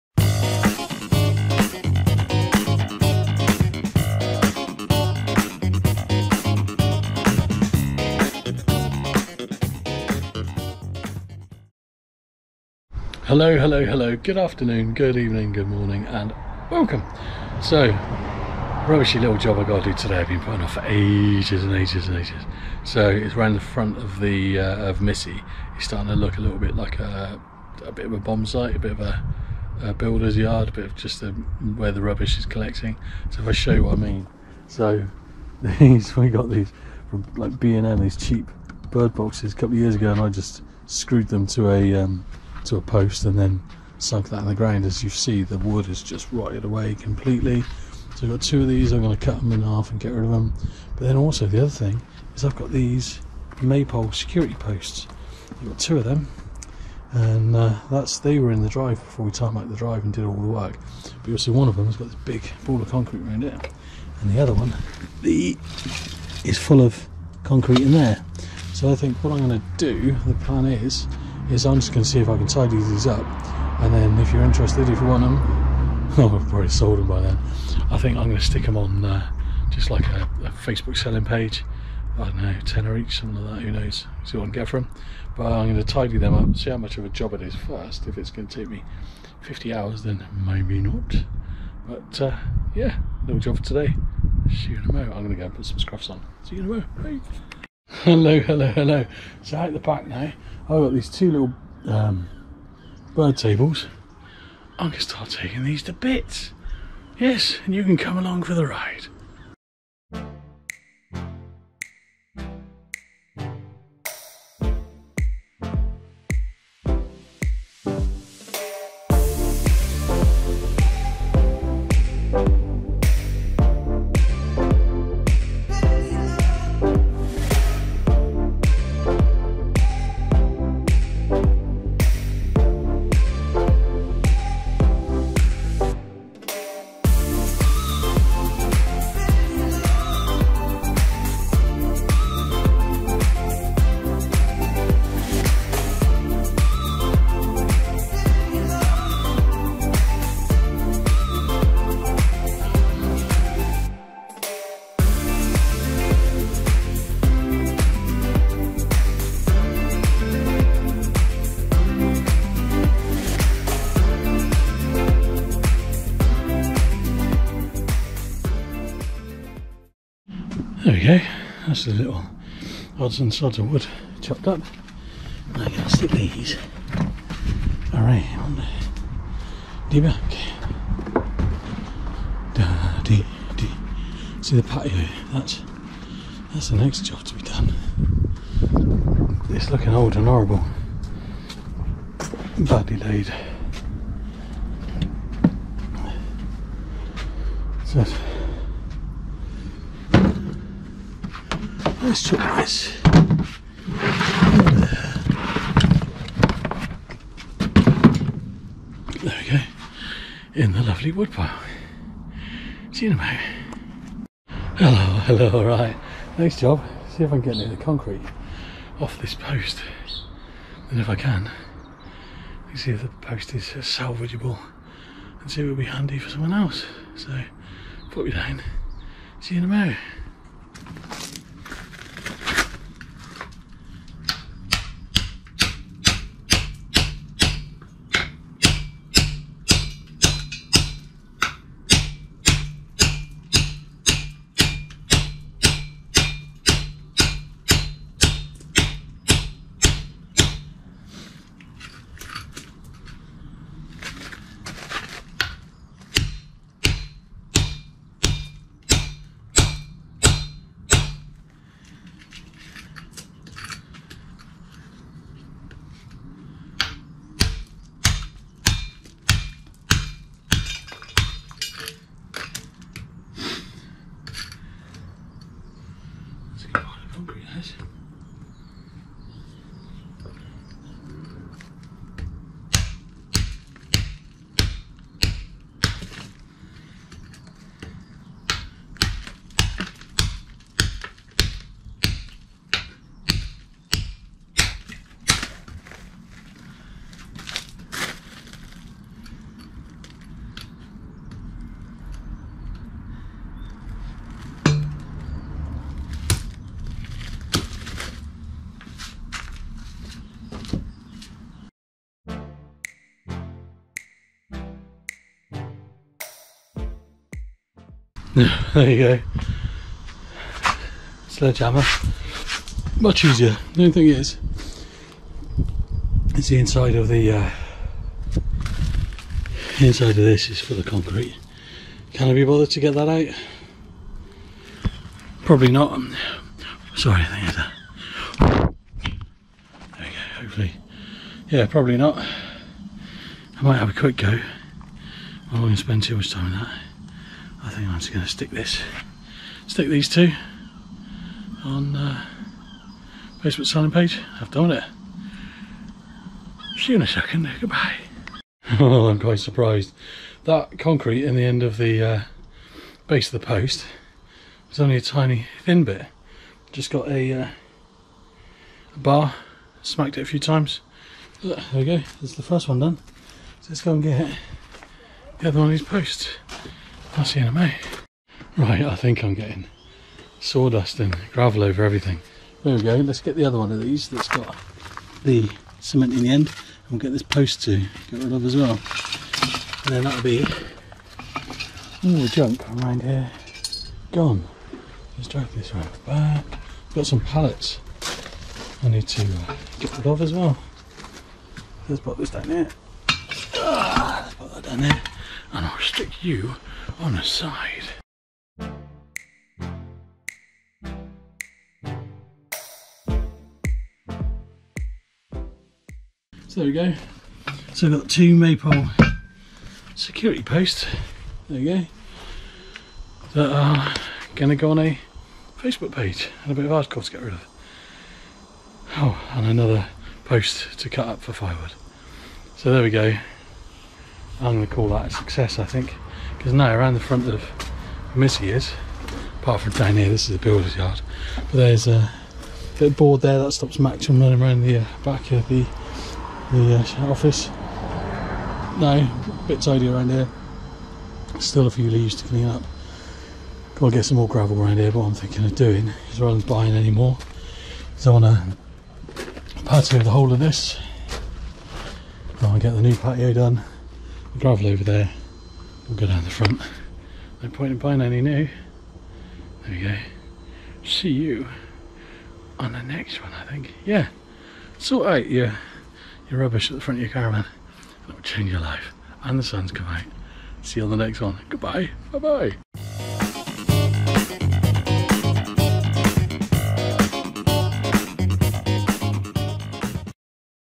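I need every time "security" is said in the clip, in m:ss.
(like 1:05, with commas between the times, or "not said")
0:54, 6:59.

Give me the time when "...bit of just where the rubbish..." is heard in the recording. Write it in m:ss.
0:30.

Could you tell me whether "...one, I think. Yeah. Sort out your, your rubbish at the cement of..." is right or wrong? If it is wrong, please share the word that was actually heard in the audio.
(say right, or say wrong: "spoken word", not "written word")
wrong: "front", not "cement".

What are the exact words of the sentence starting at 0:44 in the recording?
As you see, the wood is just rotted away completely.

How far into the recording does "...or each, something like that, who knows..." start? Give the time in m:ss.
1:22.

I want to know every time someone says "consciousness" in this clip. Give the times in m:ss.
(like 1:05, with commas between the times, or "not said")
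not said.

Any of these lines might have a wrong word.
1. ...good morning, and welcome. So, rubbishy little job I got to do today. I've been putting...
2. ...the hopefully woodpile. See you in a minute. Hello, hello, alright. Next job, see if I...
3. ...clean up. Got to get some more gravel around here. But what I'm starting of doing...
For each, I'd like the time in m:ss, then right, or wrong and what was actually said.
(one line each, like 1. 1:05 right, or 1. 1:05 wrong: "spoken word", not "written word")
1. 0:15 right
2. 3:30 wrong: "lovely", not "hopefully"
3. 7:32 wrong: "thinking", not "starting".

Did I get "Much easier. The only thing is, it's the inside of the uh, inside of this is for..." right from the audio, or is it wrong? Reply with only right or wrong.
right.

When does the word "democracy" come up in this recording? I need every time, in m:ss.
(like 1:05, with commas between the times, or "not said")
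not said.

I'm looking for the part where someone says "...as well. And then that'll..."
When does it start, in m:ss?
6:28.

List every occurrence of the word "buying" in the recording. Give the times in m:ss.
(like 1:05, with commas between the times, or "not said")
7:36, 7:47.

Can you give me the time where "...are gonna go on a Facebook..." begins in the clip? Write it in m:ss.
7:03.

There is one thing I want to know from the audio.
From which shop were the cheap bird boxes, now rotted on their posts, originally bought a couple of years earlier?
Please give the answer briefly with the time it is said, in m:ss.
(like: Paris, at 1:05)
B and M, at 0:37.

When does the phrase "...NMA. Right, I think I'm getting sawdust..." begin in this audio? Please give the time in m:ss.
6:17.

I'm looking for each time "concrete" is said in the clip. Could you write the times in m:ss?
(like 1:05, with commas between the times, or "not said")
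1:02, 1:07, 3:37, 5:30, 6:00.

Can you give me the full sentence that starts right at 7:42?
I'll get the new patio done.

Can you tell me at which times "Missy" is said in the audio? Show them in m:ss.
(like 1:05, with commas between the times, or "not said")
0:24, 7:18.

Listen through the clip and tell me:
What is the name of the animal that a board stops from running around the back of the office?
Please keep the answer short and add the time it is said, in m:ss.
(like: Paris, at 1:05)
Max, at 7:23.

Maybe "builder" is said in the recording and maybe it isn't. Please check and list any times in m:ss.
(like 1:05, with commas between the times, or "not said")
0:29, 7:20.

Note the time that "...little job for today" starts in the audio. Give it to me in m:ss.
1:33.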